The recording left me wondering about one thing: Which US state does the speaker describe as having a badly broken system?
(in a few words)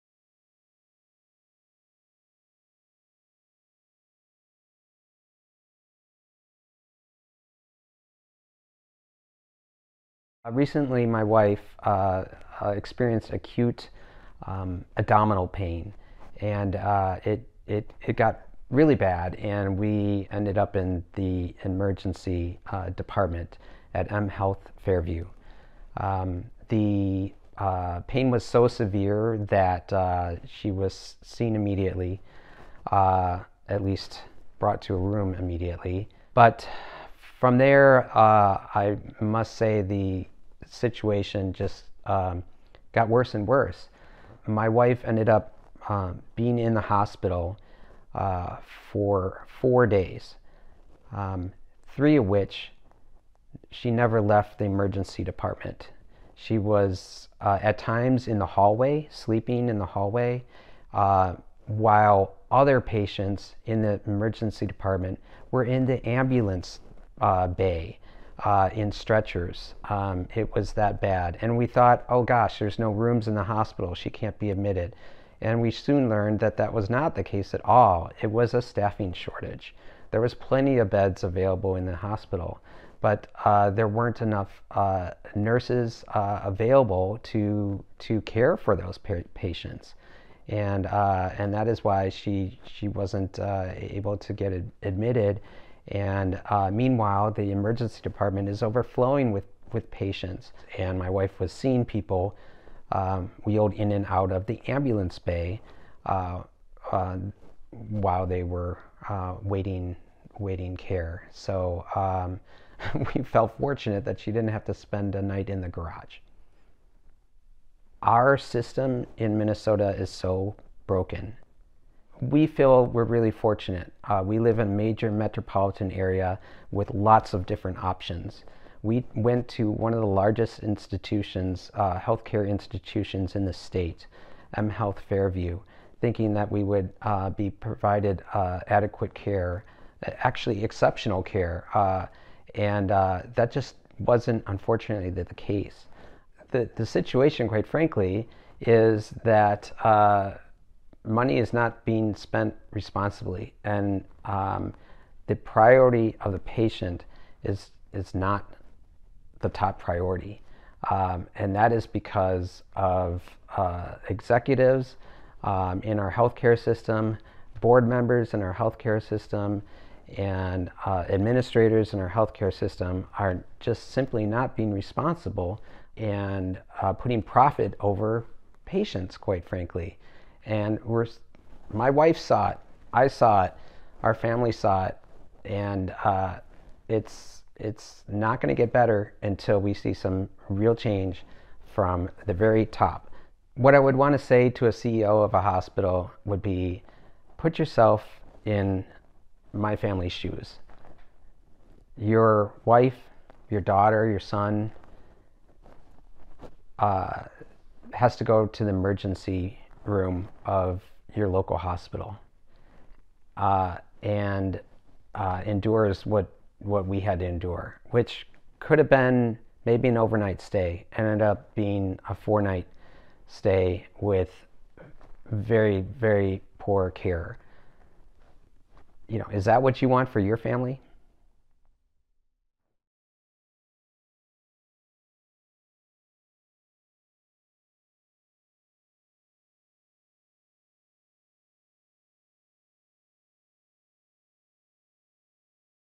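Minnesota.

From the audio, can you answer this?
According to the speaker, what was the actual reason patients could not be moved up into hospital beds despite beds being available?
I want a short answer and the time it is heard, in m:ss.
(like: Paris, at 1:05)
Staffing shortage, at 1:18.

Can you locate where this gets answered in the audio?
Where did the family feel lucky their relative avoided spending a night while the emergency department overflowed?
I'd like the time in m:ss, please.
1:55.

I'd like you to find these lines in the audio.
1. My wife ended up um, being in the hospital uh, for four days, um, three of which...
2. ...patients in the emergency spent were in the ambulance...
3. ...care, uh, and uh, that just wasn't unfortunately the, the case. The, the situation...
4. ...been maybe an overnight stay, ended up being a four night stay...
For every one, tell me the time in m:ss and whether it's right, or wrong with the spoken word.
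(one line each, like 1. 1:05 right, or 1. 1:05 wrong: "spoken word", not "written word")
1. 0:44 right
2. 1:02 wrong: "department", not "spent"
3. 2:21 right
4. 3:38 right.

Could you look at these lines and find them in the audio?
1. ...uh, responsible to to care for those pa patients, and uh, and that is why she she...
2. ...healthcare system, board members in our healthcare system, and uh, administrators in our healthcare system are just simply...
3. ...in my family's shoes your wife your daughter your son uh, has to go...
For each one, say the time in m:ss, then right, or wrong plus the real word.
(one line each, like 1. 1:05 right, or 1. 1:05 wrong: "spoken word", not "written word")
1. 1:26 wrong: "available", not "responsible"
2. 2:46 right
3. 3:18 right.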